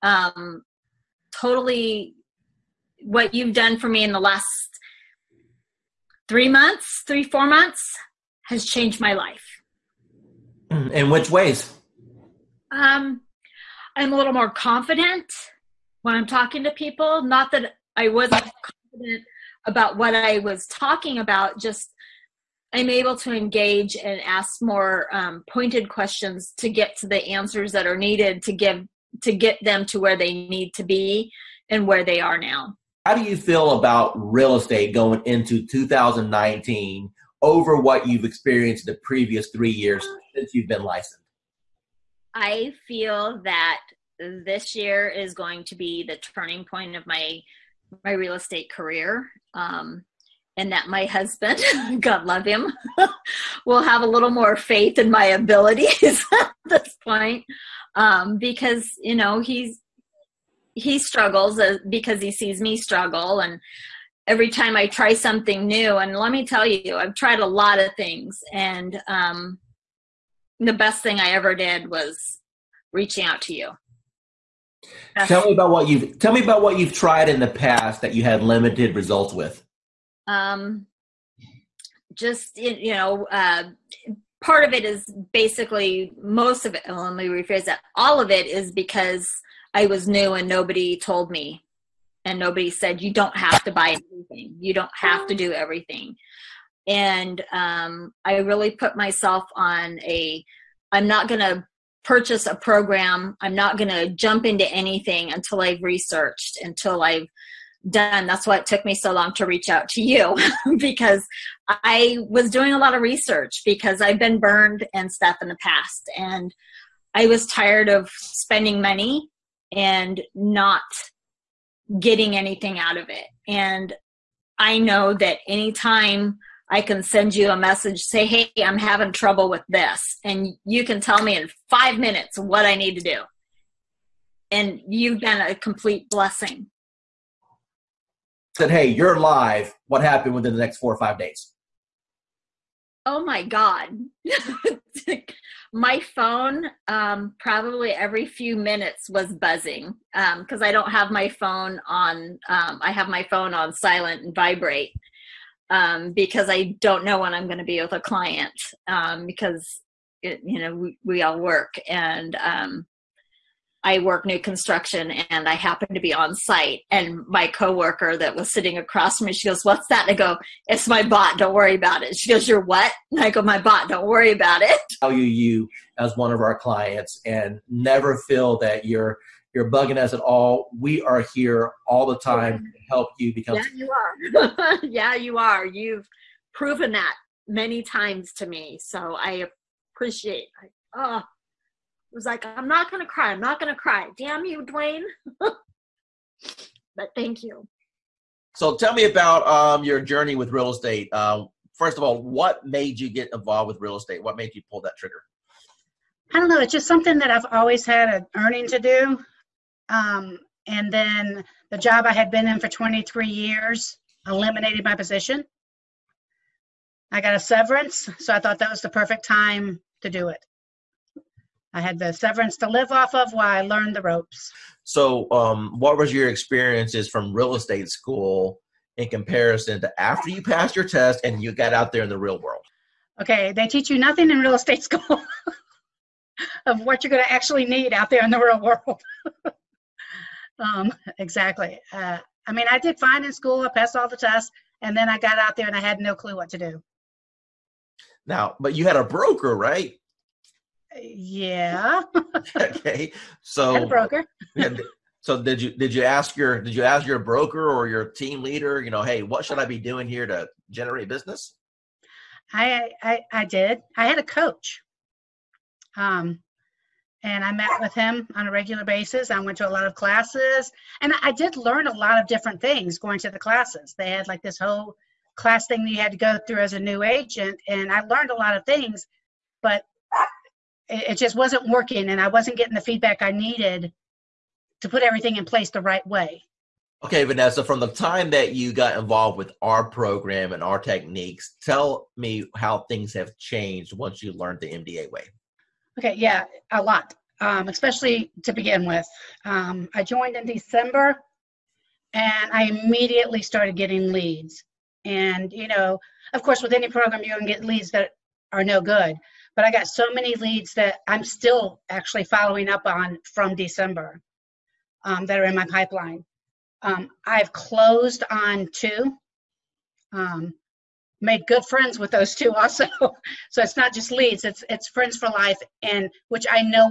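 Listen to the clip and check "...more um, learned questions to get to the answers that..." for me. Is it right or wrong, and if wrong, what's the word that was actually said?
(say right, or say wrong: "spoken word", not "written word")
wrong: "pointed", not "learned".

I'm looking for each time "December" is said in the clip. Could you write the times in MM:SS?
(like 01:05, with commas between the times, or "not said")
05:00, 05:13.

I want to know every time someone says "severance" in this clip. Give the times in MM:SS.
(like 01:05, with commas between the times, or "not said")
03:37, 03:42.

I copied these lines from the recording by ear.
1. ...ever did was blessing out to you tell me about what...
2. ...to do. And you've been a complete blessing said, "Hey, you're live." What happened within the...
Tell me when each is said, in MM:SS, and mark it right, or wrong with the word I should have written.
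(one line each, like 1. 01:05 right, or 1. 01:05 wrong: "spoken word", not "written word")
1. 01:11 wrong: "reaching", not "blessing"
2. 02:12 right.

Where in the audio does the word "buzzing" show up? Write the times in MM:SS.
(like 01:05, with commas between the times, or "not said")
02:29.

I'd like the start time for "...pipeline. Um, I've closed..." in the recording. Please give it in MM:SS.
05:15.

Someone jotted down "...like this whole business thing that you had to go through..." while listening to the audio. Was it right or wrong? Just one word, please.
wrong.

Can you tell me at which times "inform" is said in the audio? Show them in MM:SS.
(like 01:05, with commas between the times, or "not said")
not said.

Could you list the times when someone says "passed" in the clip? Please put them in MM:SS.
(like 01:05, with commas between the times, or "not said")
03:50, 04:03.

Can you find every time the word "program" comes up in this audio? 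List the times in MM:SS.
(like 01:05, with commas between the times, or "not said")
01:42, 04:49, 05:06.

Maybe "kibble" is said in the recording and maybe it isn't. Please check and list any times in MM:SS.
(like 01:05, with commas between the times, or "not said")
not said.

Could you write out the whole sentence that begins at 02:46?
And my coworker that was sitting across from me, she goes, What's that?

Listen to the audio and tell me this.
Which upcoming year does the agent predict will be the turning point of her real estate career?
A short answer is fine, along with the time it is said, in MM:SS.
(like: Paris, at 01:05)
2019, at 00:35.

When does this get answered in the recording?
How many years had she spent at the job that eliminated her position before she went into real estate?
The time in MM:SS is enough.
03:32.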